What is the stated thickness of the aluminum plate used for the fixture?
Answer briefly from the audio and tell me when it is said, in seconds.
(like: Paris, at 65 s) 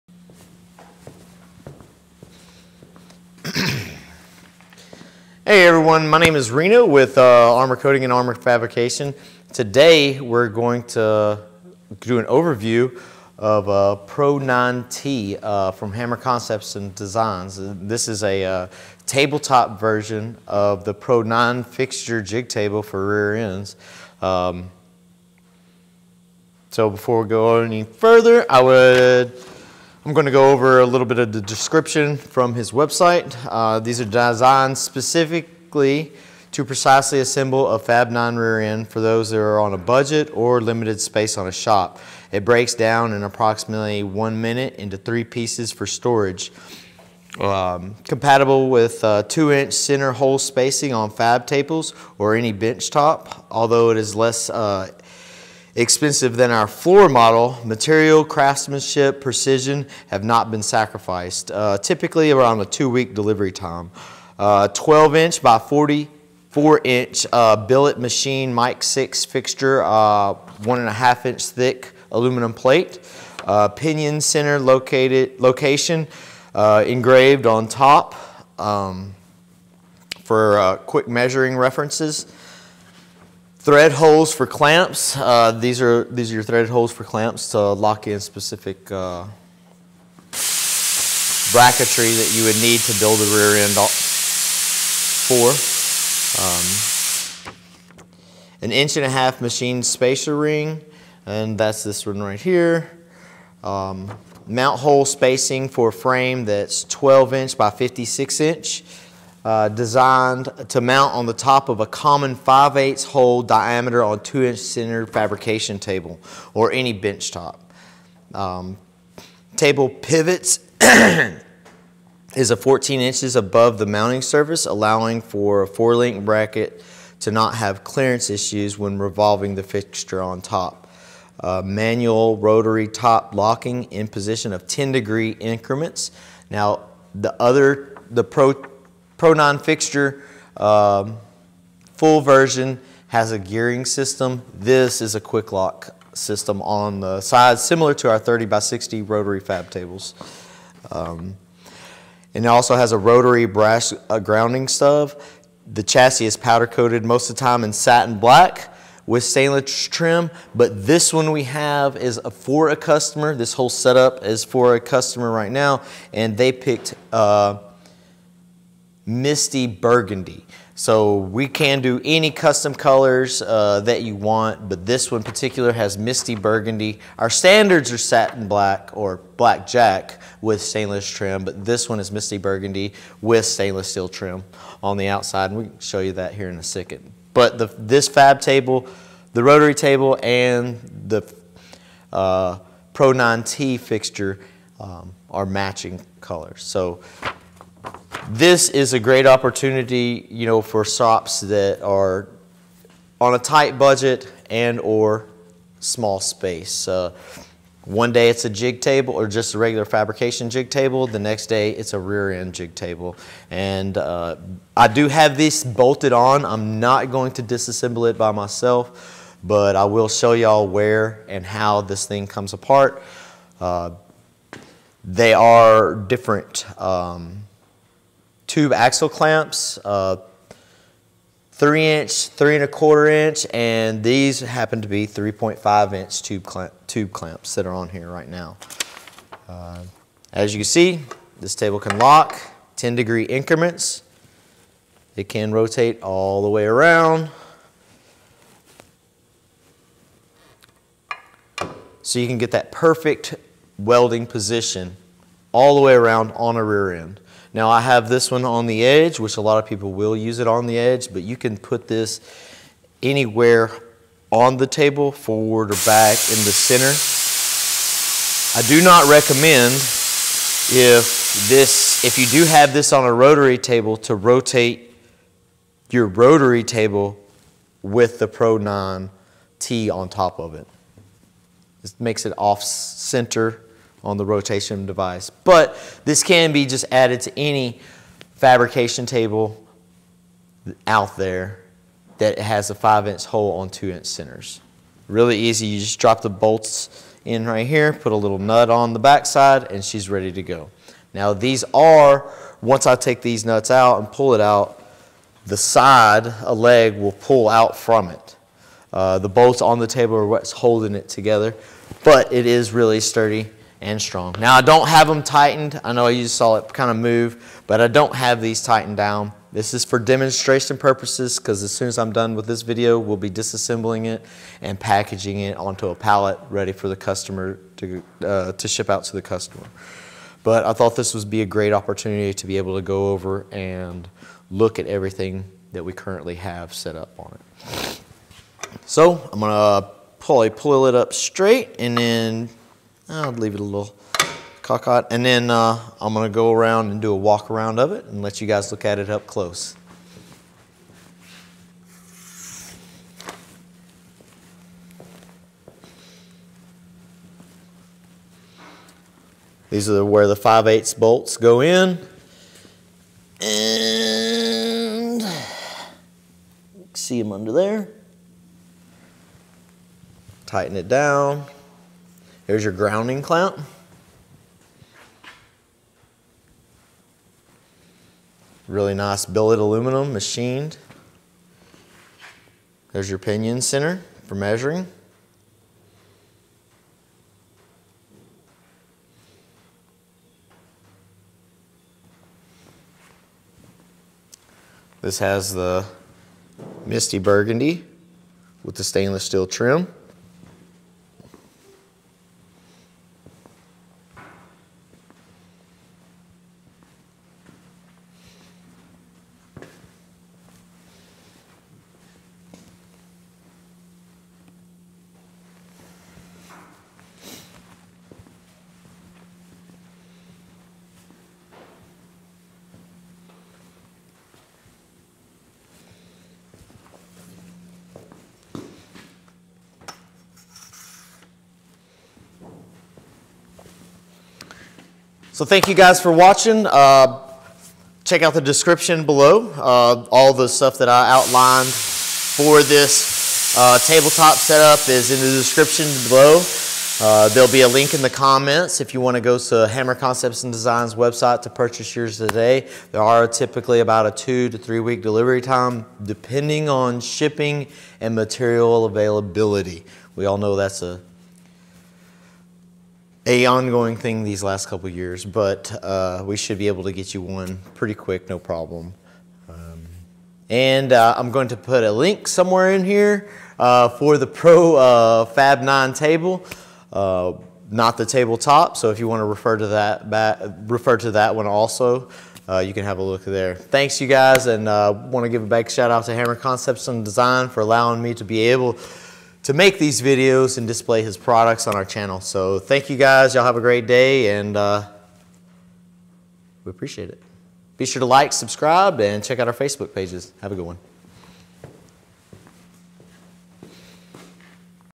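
1.5 inch, at 70 s.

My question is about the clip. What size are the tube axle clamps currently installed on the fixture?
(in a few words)
3.5 inch.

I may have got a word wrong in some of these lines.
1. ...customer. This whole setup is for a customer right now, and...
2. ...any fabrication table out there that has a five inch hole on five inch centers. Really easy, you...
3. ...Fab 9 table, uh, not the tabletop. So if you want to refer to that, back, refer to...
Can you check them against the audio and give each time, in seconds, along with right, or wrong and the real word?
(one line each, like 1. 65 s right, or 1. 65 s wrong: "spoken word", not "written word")
1. 162 s right
2. 287 s wrong: "two", not "five"
3. 475 s right.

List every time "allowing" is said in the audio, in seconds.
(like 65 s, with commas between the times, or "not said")
124 s, 487 s.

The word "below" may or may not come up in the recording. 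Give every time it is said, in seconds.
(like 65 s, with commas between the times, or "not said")
439 s, 446 s.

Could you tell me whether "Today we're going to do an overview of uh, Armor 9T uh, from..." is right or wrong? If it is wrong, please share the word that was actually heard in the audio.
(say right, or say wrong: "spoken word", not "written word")
wrong: "Pro", not "Armor".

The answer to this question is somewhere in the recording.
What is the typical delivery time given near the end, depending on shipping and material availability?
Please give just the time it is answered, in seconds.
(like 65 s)
454 s.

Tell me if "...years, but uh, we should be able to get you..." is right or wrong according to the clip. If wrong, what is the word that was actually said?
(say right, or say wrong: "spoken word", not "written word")
right.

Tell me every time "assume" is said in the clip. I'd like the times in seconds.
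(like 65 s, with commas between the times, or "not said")
not said.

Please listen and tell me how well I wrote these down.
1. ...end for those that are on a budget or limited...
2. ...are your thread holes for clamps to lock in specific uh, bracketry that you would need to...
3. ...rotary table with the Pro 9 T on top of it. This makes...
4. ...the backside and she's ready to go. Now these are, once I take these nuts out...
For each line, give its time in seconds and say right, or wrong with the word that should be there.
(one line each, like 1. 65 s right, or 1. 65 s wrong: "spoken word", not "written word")
1. 38 s right
2. 86 s right
3. 276 s right
4. 298 s right.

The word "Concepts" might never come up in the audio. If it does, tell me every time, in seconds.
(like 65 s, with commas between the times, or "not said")
16 s, 449 s, 486 s.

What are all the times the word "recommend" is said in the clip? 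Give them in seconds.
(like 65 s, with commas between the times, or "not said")
269 s.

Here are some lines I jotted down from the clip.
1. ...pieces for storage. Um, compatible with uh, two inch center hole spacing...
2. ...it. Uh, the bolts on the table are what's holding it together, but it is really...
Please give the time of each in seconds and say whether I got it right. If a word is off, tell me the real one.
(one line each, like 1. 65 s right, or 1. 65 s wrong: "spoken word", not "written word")
1. 45 s right
2. 308 s right.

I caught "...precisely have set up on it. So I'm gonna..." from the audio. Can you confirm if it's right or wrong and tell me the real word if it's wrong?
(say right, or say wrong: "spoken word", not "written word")
wrong: "currently", not "precisely".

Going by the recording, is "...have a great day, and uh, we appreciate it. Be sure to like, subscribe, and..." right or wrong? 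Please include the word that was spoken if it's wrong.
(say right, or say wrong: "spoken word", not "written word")
right.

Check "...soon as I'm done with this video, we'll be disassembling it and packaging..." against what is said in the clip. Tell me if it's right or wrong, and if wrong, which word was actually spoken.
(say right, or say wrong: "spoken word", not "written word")
right.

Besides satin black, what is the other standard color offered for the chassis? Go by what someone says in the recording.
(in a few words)
Black jack.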